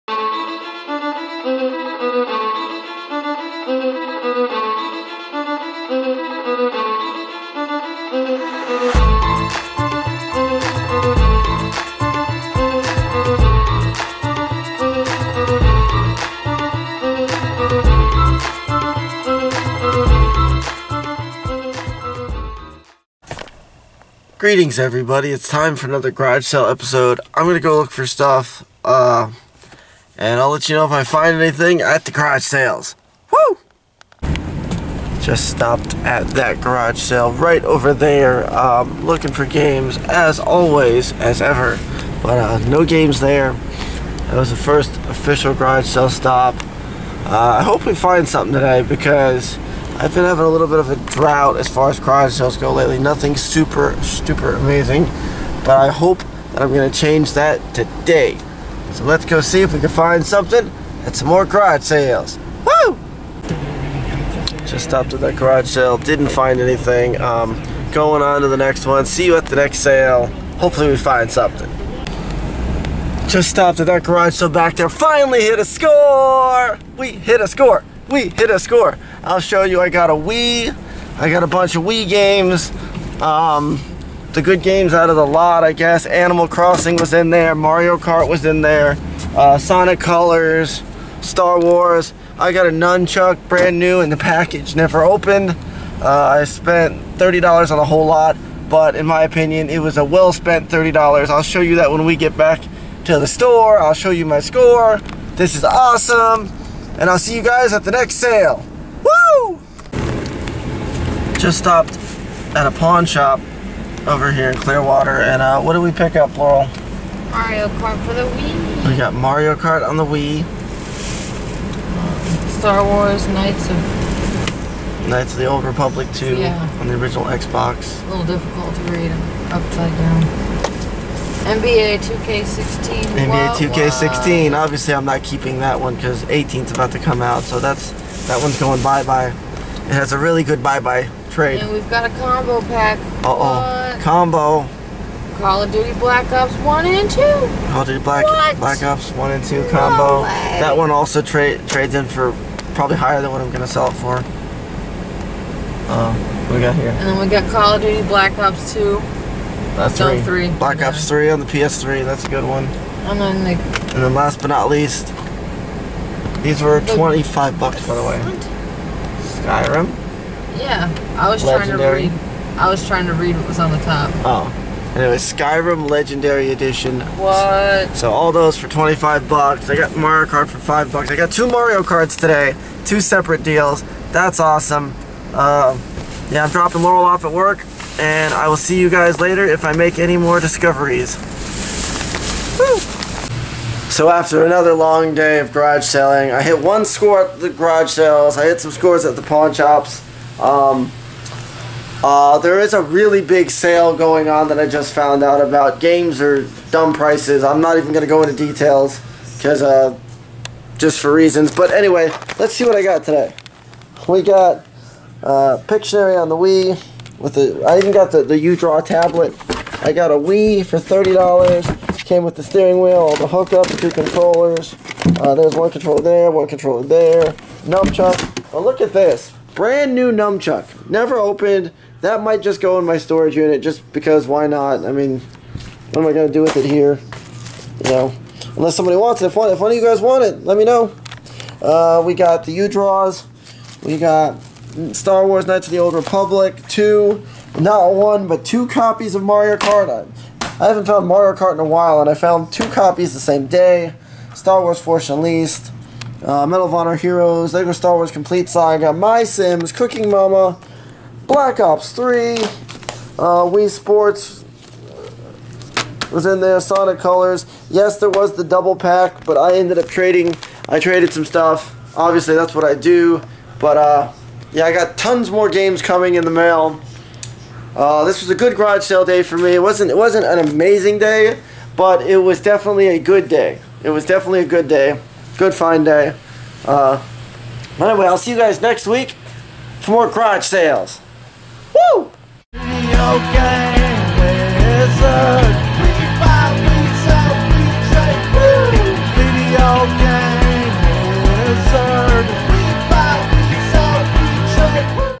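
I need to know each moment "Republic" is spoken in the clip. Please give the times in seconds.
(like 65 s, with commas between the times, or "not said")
125 s, 245 s.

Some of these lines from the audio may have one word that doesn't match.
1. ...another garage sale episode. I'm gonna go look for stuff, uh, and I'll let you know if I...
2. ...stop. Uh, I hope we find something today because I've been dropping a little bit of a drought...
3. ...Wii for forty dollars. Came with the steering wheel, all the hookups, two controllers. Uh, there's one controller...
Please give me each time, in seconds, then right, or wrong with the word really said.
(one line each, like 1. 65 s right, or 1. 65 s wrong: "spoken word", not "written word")
1. 25 s right
2. 46 s wrong: "having", not "dropping"
3. 220 s wrong: "thirty", not "forty".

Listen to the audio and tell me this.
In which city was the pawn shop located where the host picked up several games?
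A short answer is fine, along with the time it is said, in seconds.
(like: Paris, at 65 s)
Clearwater, at 114 s.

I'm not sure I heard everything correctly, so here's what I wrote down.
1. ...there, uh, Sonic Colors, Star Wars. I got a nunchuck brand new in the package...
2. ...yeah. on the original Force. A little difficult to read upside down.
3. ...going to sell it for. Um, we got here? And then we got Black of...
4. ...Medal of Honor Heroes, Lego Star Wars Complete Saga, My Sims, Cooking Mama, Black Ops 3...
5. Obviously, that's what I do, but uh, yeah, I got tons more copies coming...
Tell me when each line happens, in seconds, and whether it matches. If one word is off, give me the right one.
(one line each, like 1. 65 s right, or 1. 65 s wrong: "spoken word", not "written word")
1. 88 s right
2. 126 s wrong: "Xbox", not "Force"
3. 153 s wrong: "Call", not "Black"
4. 256 s right
5. 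271 s wrong: "games", not "copies".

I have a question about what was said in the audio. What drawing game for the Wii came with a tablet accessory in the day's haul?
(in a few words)
Pictionary.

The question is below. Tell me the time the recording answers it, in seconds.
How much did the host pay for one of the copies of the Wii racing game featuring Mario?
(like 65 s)
180 s.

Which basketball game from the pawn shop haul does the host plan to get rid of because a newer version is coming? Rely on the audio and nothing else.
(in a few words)
NBA 2K16.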